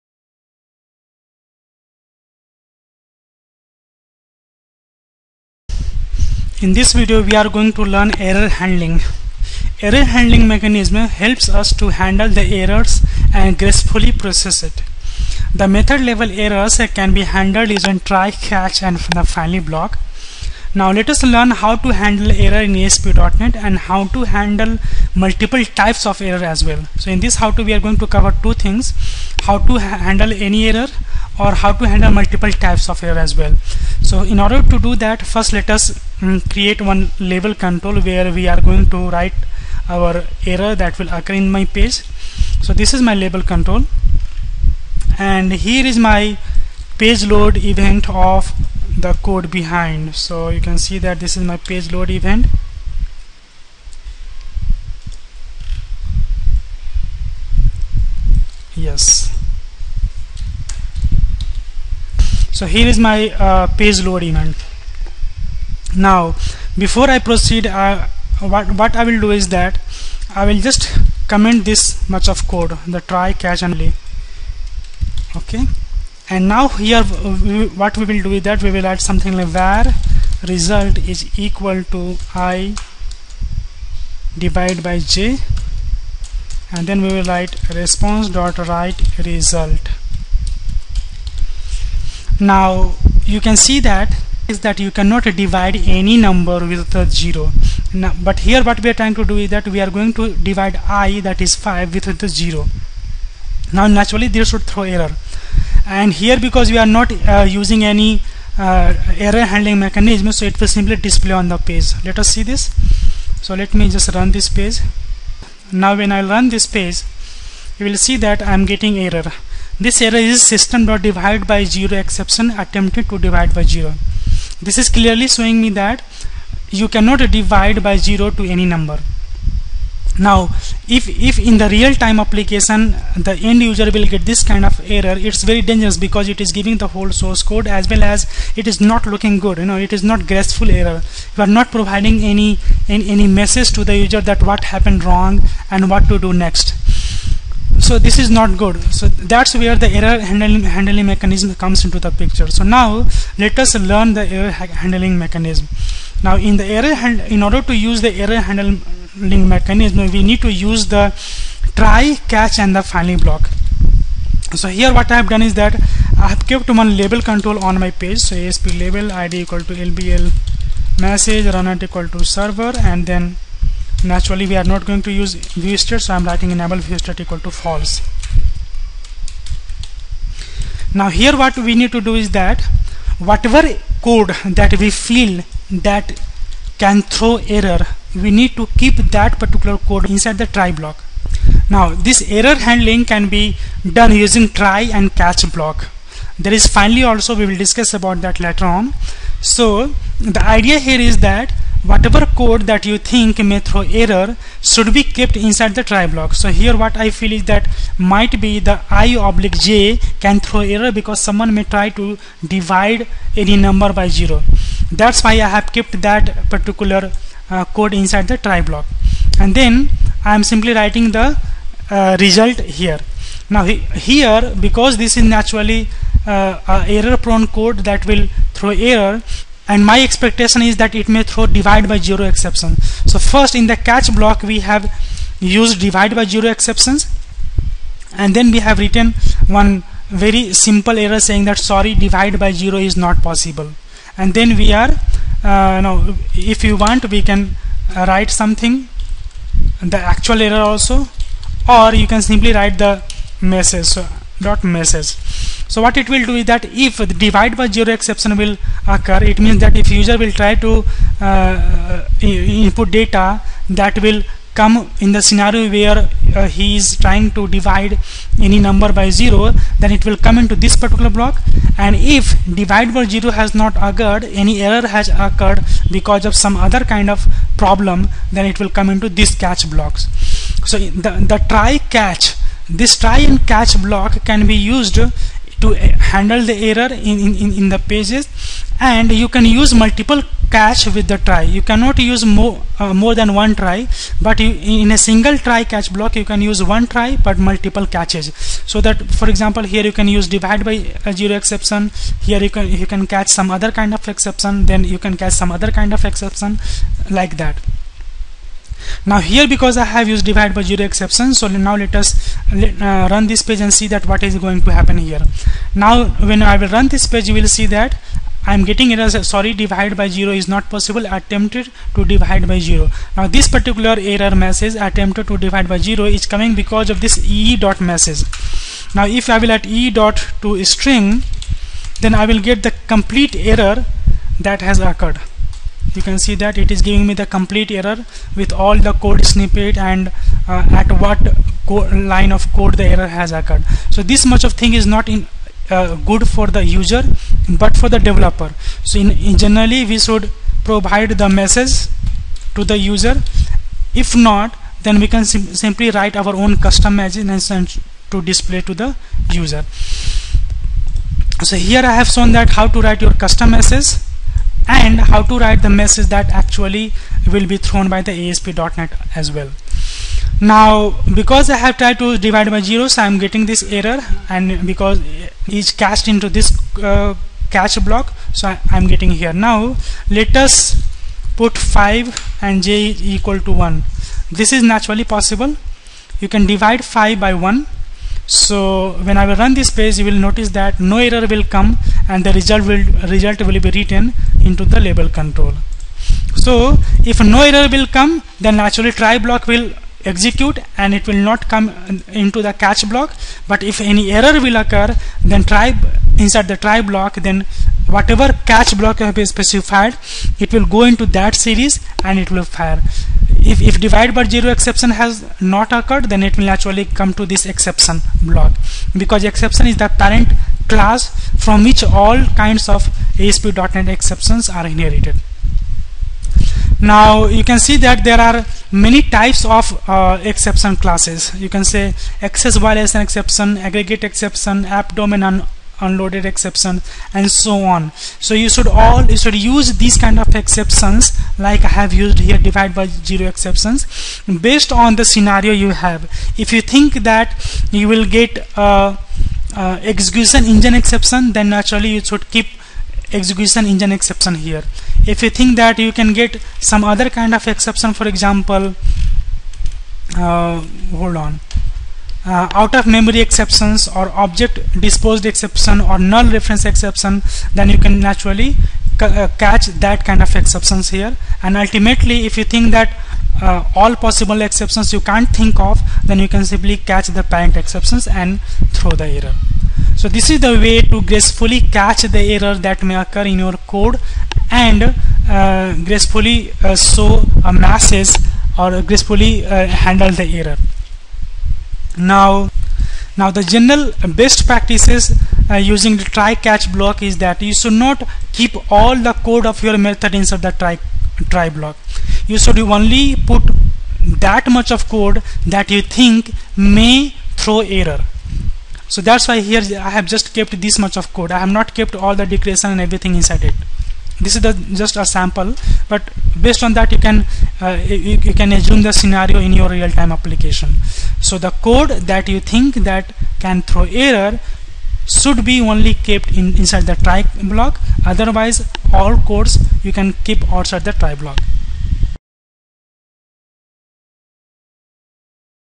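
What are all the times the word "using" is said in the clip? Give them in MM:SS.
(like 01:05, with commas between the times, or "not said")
00:17, 01:47, 03:14, 08:15.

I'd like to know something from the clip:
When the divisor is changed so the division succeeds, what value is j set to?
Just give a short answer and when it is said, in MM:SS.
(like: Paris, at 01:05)
1, at 06:22.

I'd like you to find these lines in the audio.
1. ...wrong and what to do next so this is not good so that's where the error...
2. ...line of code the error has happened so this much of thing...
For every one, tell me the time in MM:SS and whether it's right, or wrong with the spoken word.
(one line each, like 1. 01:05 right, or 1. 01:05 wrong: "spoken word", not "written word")
1. 02:25 right
2. 05:41 wrong: "occurred", not "happened".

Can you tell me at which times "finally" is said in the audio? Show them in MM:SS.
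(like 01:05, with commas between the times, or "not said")
00:19, 02:42, 03:16.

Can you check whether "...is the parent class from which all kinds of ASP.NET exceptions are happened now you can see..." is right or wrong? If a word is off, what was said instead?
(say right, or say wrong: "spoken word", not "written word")
wrong: "inherited", not "happened".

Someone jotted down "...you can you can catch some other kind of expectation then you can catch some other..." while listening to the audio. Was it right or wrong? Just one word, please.
wrong.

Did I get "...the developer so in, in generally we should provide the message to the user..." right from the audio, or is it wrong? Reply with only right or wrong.
right.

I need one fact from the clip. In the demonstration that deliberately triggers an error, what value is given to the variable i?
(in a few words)
5.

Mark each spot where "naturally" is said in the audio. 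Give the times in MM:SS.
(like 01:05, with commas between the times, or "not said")
01:43, 02:54, 03:45, 06:24, 06:38, 06:56, 07:31, 07:47.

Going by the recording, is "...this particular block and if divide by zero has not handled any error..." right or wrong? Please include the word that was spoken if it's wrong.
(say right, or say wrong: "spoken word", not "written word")
wrong: "occurred", not "handled".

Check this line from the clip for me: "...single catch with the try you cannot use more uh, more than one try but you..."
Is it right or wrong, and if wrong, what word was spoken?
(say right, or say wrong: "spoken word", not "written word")
wrong: "multiple", not "single".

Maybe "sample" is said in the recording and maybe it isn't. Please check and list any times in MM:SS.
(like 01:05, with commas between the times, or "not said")
08:35.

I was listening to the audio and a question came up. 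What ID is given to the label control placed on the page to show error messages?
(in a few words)
LBL message.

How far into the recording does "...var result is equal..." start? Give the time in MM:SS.
01:19.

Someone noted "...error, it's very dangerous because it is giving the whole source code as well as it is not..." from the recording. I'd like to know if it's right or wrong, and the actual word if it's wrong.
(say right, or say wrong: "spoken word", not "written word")
right.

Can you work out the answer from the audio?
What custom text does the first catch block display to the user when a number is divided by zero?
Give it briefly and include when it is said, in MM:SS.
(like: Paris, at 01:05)
sorry divide by zero is not possible, at 04:01.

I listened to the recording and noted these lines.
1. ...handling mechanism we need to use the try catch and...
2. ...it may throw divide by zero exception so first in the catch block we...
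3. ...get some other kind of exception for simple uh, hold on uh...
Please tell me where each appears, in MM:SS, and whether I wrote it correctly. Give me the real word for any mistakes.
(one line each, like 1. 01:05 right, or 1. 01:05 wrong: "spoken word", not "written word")
1. 02:38 right
2. 03:51 right
3. 07:36 wrong: "example", not "simple".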